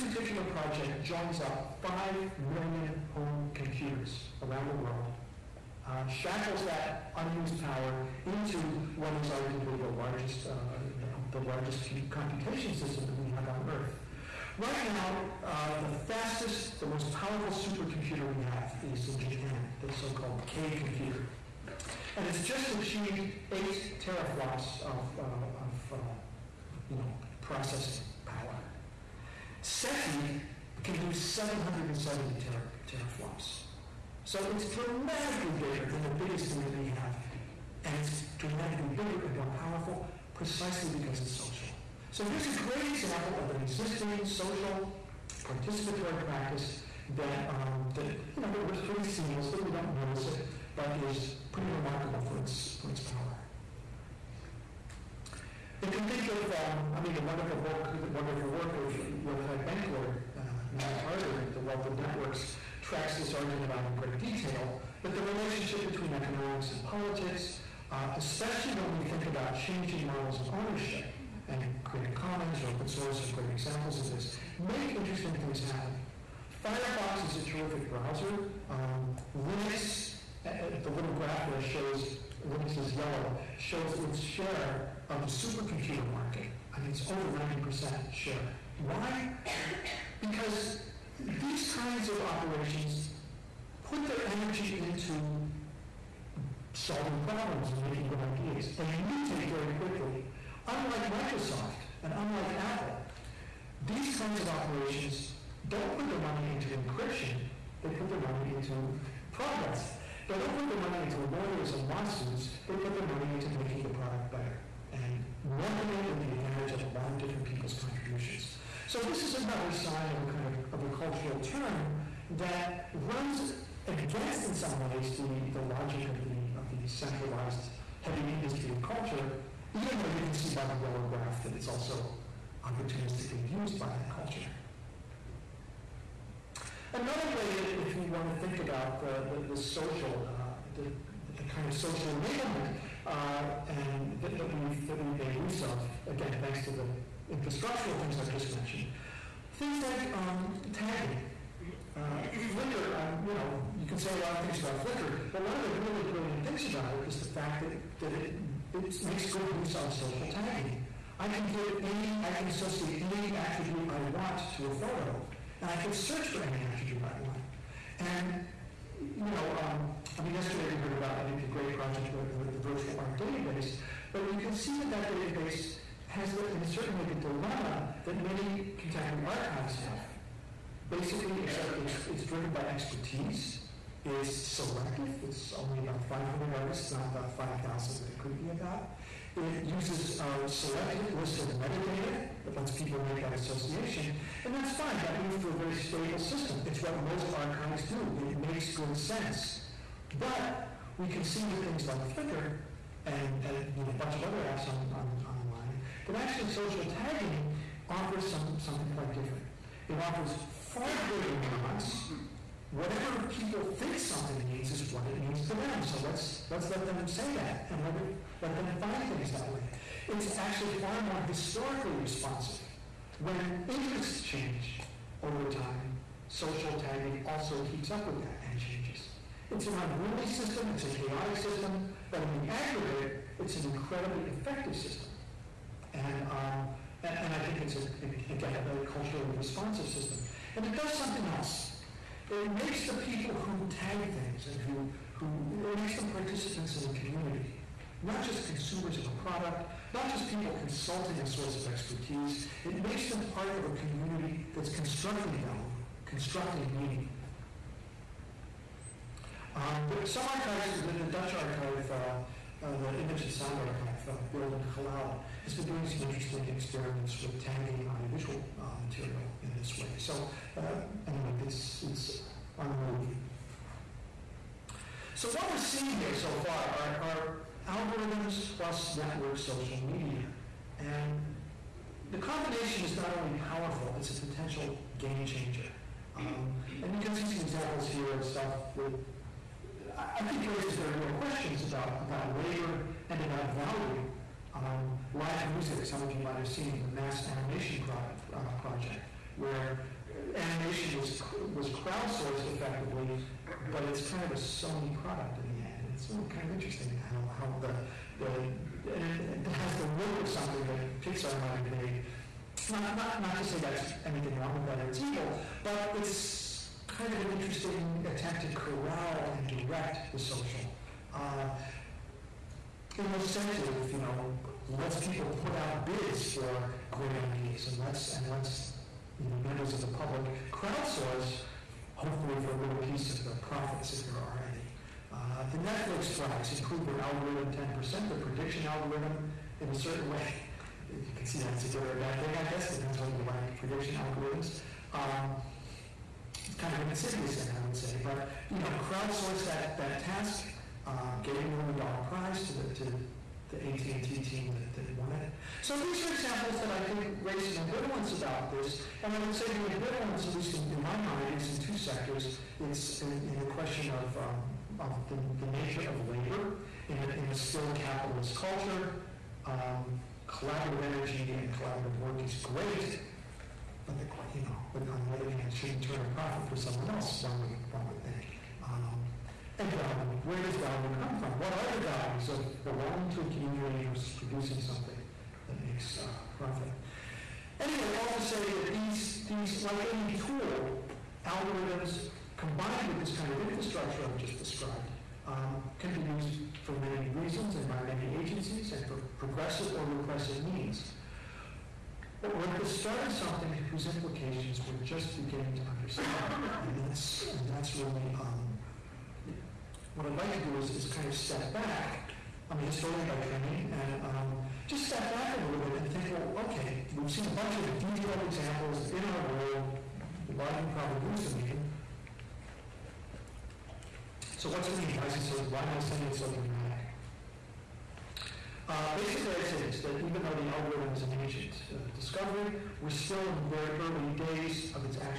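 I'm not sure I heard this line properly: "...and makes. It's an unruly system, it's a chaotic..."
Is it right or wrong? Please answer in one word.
wrong.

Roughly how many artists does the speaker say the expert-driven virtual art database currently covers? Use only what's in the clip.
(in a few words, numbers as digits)
500.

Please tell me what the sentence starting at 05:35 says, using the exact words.
Uh, the Netflix prize improved their algorithm 10%, their prediction algorithm in a certain way.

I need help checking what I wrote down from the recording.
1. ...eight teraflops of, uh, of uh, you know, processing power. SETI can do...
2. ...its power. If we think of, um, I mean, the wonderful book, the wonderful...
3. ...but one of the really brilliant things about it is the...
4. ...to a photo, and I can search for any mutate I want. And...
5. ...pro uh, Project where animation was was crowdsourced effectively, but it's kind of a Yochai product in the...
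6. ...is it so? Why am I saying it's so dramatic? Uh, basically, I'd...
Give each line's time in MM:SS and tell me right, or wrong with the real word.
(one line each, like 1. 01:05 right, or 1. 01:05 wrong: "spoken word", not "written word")
1. 00:23 right
2. 00:52 right
3. 02:35 right
4. 02:44 wrong: "attribute", not "mutate"
5. 04:57 wrong: "Sony", not "Yochai"
6. 07:05 right.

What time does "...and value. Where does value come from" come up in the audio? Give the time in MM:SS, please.
06:19.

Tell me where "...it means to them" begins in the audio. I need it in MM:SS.
03:35.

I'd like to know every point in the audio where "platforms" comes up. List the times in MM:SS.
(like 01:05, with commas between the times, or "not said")
not said.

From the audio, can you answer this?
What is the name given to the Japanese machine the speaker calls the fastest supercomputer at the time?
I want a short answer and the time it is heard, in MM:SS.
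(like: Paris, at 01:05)
K computer, at 00:20.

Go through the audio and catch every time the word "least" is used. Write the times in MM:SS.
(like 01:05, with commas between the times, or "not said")
06:00.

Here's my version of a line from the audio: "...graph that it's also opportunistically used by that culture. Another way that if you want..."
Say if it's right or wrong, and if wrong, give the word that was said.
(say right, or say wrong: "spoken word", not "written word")
right.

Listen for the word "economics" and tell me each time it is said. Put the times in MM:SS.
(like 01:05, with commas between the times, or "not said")
01:06.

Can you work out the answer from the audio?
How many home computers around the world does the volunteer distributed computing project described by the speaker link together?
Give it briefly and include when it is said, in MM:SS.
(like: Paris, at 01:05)
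5 million, at 00:01.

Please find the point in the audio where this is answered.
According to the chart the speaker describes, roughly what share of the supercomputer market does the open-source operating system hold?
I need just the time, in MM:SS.
01:27.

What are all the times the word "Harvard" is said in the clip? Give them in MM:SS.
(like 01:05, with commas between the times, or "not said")
01:01.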